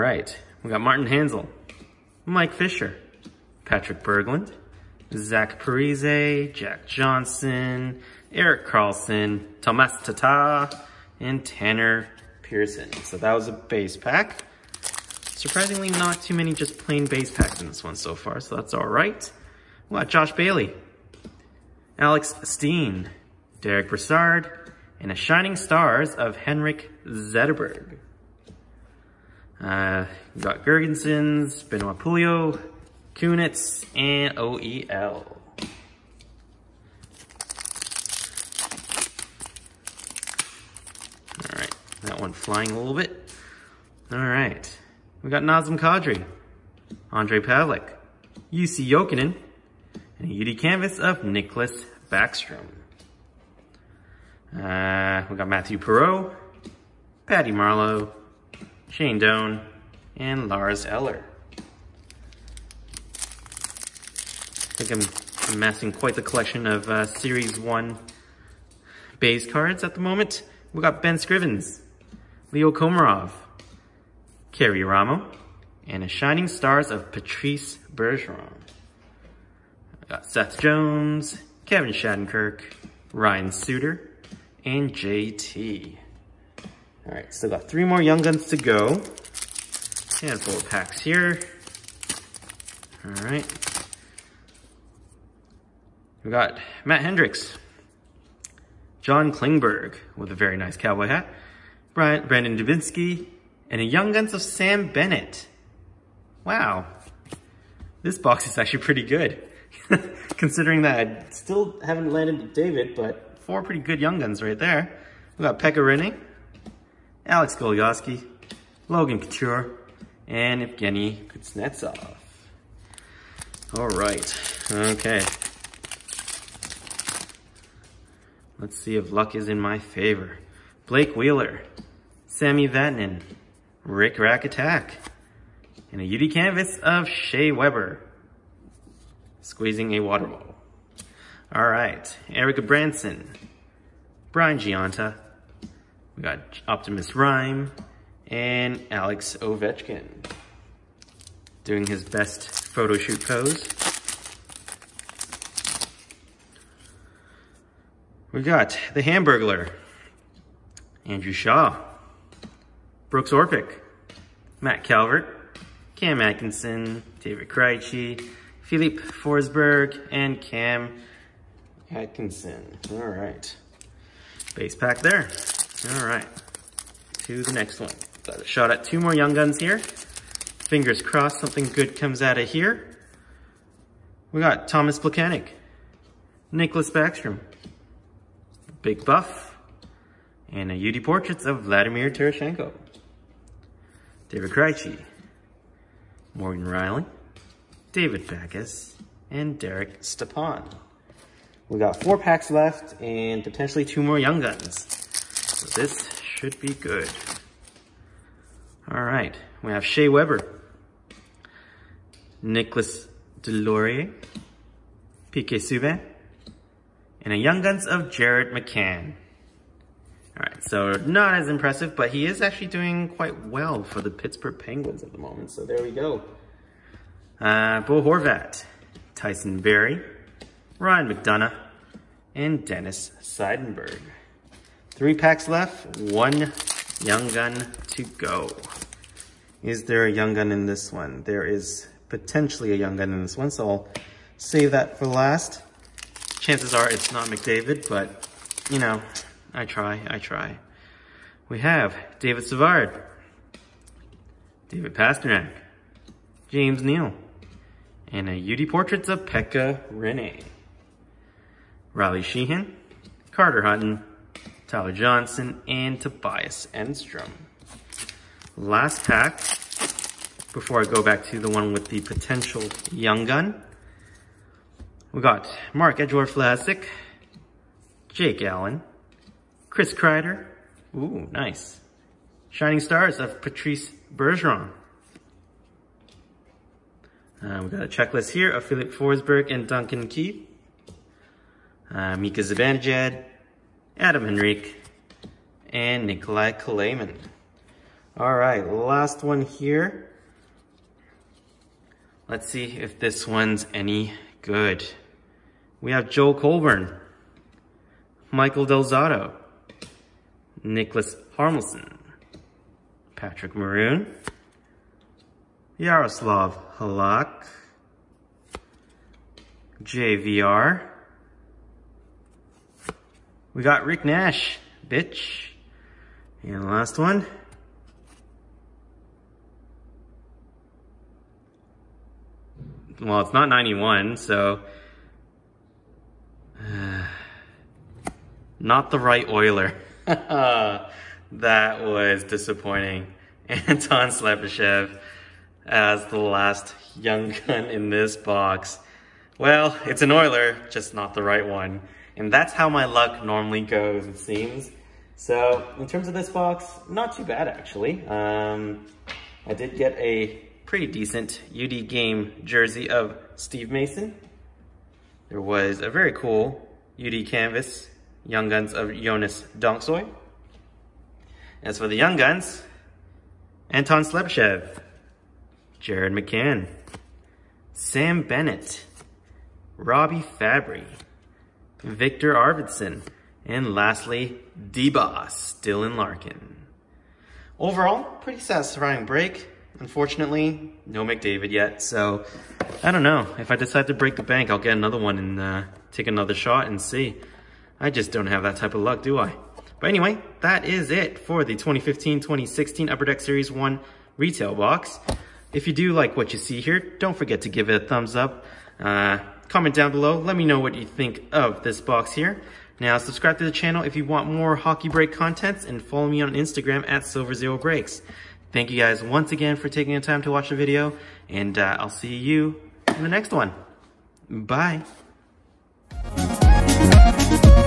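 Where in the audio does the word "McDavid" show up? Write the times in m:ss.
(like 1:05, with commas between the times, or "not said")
4:07, 6:31.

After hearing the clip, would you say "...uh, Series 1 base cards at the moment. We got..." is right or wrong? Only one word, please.
right.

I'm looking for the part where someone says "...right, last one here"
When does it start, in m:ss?
4:58.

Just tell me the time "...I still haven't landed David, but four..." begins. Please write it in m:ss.
1:51.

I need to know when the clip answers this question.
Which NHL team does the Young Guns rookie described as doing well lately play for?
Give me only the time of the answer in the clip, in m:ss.
3:44.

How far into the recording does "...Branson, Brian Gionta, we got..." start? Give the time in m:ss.
2:22.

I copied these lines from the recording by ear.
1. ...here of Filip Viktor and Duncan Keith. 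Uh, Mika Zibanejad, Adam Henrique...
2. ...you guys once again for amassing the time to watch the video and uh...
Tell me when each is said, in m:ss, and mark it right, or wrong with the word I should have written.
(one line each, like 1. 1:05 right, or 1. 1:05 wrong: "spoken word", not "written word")
1. 4:48 wrong: "Forsberg", not "Viktor"
2. 6:58 wrong: "taking", not "amassing".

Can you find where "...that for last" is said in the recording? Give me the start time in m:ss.
4:04.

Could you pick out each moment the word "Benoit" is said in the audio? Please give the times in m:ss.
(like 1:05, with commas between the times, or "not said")
0:31.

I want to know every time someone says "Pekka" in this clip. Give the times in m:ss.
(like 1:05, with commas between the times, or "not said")
1:55, 4:19.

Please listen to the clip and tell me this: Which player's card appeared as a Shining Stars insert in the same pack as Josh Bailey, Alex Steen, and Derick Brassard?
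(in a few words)
Henrik Zetterberg.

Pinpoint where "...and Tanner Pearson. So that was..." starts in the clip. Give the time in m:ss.
0:11.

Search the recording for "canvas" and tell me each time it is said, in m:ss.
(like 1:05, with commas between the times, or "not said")
0:50, 2:16, 6:07.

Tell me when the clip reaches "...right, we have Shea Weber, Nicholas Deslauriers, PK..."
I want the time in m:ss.
3:29.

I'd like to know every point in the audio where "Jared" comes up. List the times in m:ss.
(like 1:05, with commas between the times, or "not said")
3:38, 6:15.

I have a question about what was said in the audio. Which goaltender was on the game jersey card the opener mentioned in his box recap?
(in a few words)
Steve Mason.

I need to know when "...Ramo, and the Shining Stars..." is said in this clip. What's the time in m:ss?
1:14.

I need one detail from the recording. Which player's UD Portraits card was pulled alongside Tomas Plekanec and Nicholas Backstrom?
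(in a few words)
Vladimir Tarasenko.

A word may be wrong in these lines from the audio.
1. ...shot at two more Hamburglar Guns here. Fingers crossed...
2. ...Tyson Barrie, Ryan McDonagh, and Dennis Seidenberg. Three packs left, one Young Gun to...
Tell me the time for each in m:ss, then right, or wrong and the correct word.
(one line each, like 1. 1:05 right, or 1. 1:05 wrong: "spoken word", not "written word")
1. 2:58 wrong: "Young", not "Hamburglar"
2. 3:49 right.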